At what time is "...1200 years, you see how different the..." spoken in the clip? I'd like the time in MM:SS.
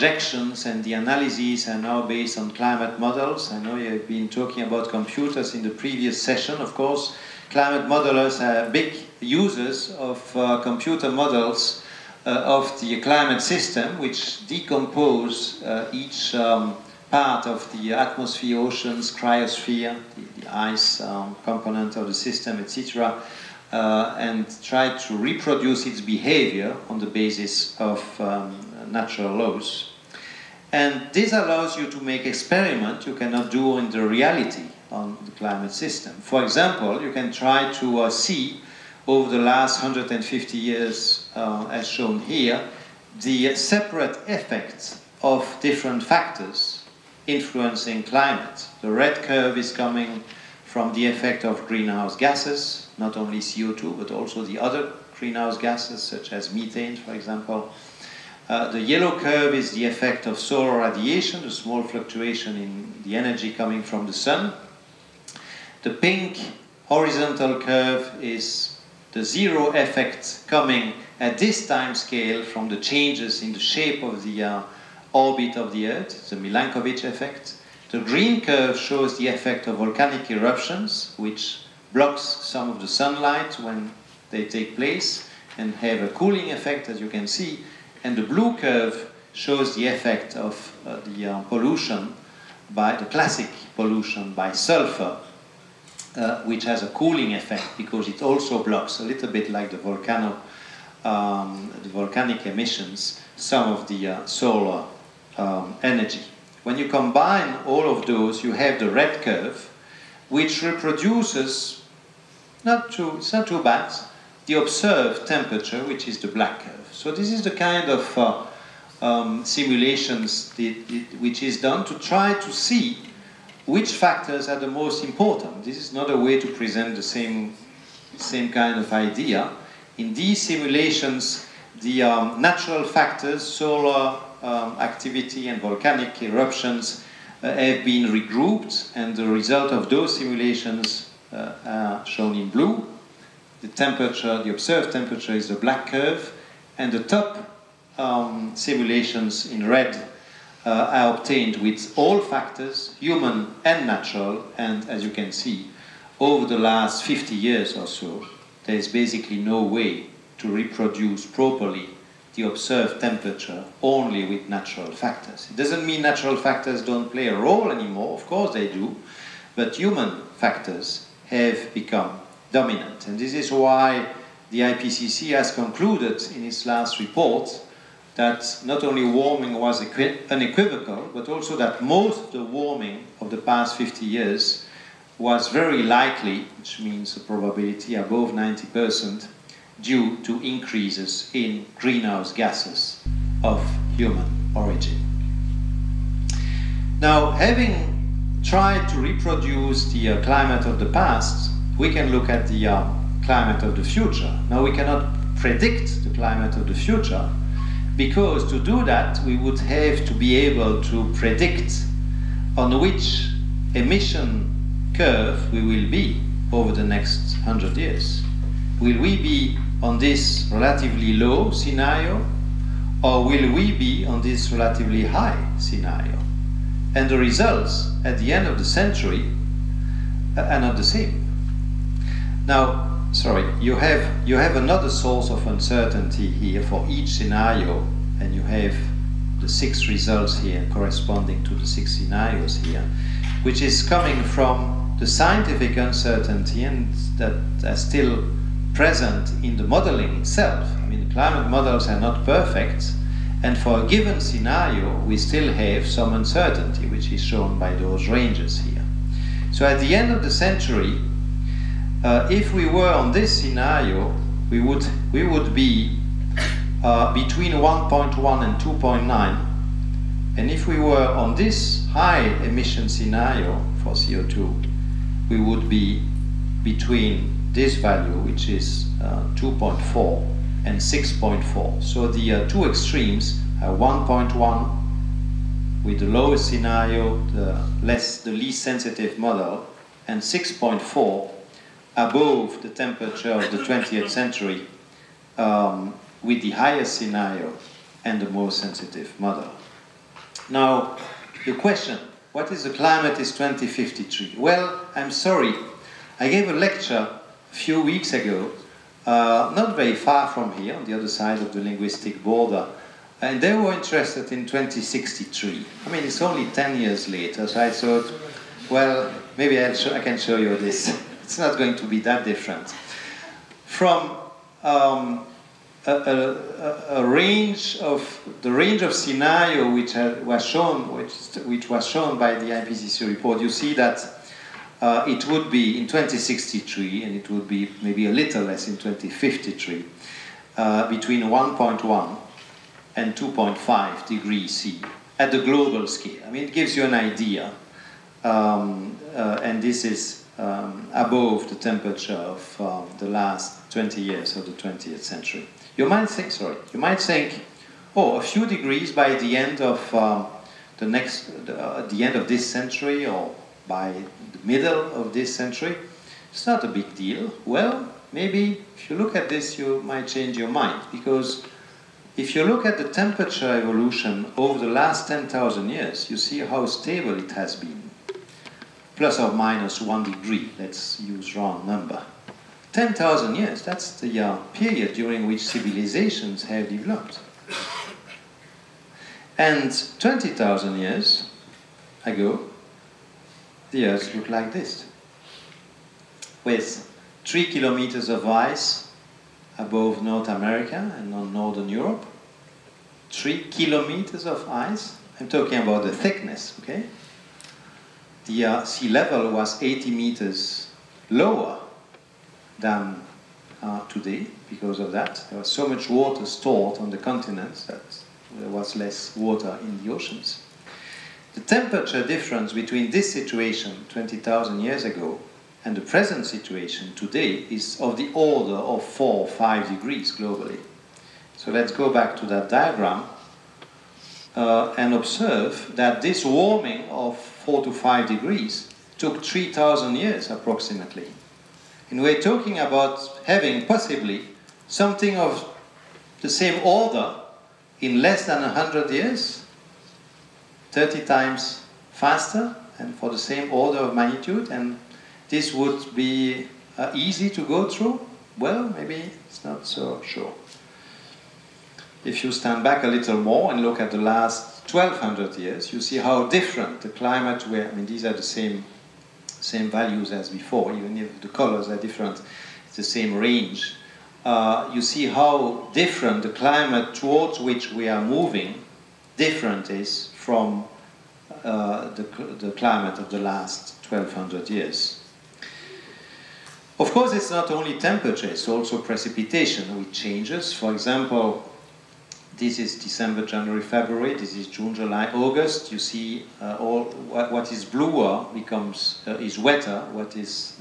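07:44.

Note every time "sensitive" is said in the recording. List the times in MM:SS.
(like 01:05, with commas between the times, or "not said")
04:48, 04:58.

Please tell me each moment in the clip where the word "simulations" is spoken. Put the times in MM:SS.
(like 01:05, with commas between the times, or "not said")
01:59, 02:10, 02:20, 02:28.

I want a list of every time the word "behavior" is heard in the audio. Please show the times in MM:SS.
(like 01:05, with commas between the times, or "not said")
00:25.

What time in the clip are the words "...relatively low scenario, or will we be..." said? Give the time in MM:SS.
03:40.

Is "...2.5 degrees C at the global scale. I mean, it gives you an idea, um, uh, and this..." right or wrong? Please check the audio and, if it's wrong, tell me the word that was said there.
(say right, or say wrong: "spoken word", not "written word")
right.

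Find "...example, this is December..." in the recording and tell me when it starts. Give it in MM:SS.
08:10.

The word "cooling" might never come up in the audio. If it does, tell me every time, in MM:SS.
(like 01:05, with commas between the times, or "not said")
01:26, 01:36.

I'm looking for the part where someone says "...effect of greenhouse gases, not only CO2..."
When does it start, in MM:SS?
00:51.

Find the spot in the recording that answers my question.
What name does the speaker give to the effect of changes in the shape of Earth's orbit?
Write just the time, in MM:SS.
01:16.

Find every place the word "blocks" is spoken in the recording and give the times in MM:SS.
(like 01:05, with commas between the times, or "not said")
01:21, 01:38.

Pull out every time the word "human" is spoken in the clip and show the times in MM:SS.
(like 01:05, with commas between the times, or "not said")
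02:32, 02:49, 03:13.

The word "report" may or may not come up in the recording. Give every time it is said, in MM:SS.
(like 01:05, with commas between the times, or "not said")
02:56, 05:33.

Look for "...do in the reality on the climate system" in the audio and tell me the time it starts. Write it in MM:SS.
00:33.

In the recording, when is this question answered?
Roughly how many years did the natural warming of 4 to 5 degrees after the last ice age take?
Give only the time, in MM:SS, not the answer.
07:19.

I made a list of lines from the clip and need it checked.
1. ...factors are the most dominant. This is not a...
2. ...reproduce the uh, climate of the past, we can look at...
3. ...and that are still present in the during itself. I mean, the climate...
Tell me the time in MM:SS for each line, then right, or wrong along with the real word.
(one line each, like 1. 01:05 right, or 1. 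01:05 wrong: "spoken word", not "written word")
1. 02:03 wrong: "important", not "dominant"
2. 03:18 right
3. 04:06 wrong: "modeling", not "during".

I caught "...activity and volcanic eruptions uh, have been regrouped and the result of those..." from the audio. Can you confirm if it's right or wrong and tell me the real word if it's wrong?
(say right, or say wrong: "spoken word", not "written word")
right.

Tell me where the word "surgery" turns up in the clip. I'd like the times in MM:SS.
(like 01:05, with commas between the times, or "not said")
not said.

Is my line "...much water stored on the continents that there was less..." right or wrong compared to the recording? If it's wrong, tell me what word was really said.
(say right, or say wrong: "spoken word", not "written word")
right.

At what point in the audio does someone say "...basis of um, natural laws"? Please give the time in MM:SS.
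00:27.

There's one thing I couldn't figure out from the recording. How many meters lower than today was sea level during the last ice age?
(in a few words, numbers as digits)
80 meters.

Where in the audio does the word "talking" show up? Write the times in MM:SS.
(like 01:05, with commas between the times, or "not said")
00:04, 06:45, 07:22.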